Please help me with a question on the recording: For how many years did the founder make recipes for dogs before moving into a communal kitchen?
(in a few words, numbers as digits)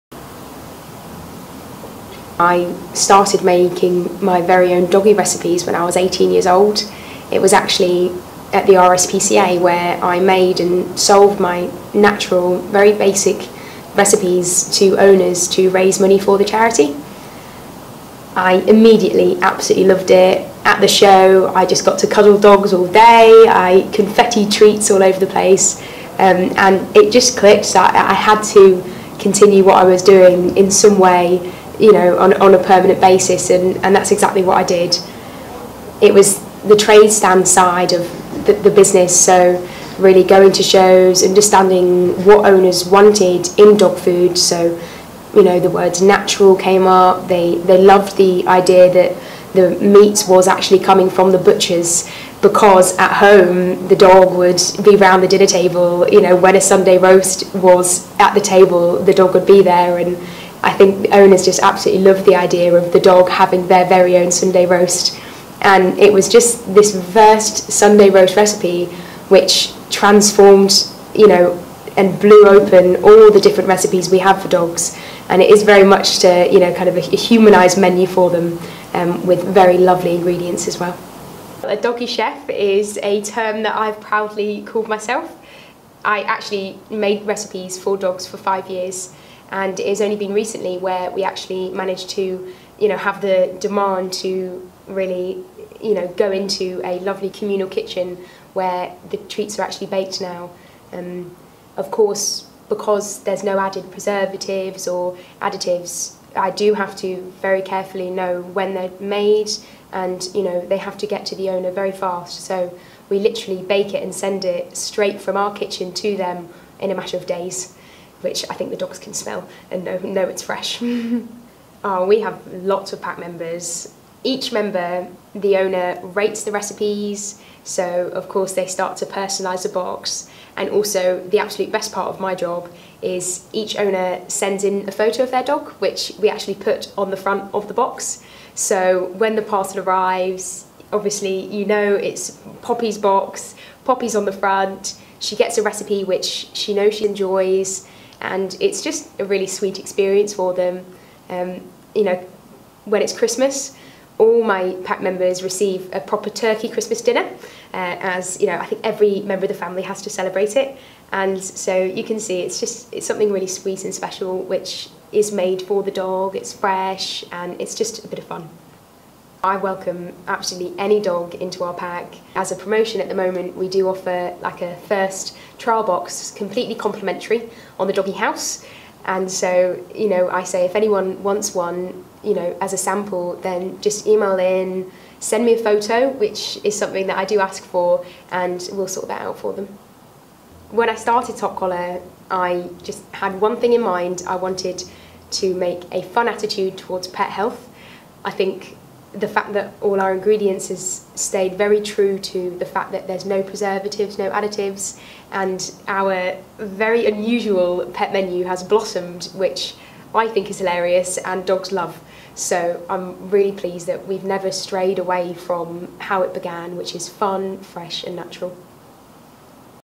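5.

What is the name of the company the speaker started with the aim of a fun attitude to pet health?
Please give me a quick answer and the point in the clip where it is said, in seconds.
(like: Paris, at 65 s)
Top Collar, at 191 s.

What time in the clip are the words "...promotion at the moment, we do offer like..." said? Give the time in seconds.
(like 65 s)
172 s.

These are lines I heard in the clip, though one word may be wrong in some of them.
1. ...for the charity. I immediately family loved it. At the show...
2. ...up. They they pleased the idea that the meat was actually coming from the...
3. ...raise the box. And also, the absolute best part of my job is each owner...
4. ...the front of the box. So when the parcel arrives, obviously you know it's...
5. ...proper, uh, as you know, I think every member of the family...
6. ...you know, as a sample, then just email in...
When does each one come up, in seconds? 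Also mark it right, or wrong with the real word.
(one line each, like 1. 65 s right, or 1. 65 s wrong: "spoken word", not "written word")
1. 16 s wrong: "absolutely", not "family"
2. 46 s wrong: "loved", not "pleased"
3. 129 s wrong: "personalise", not "raise"
4. 137 s right
5. 157 s wrong: "dinner", not "proper"
6. 182 s right.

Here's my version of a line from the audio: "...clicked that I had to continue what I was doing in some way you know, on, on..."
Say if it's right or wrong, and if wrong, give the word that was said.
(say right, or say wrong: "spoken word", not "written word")
right.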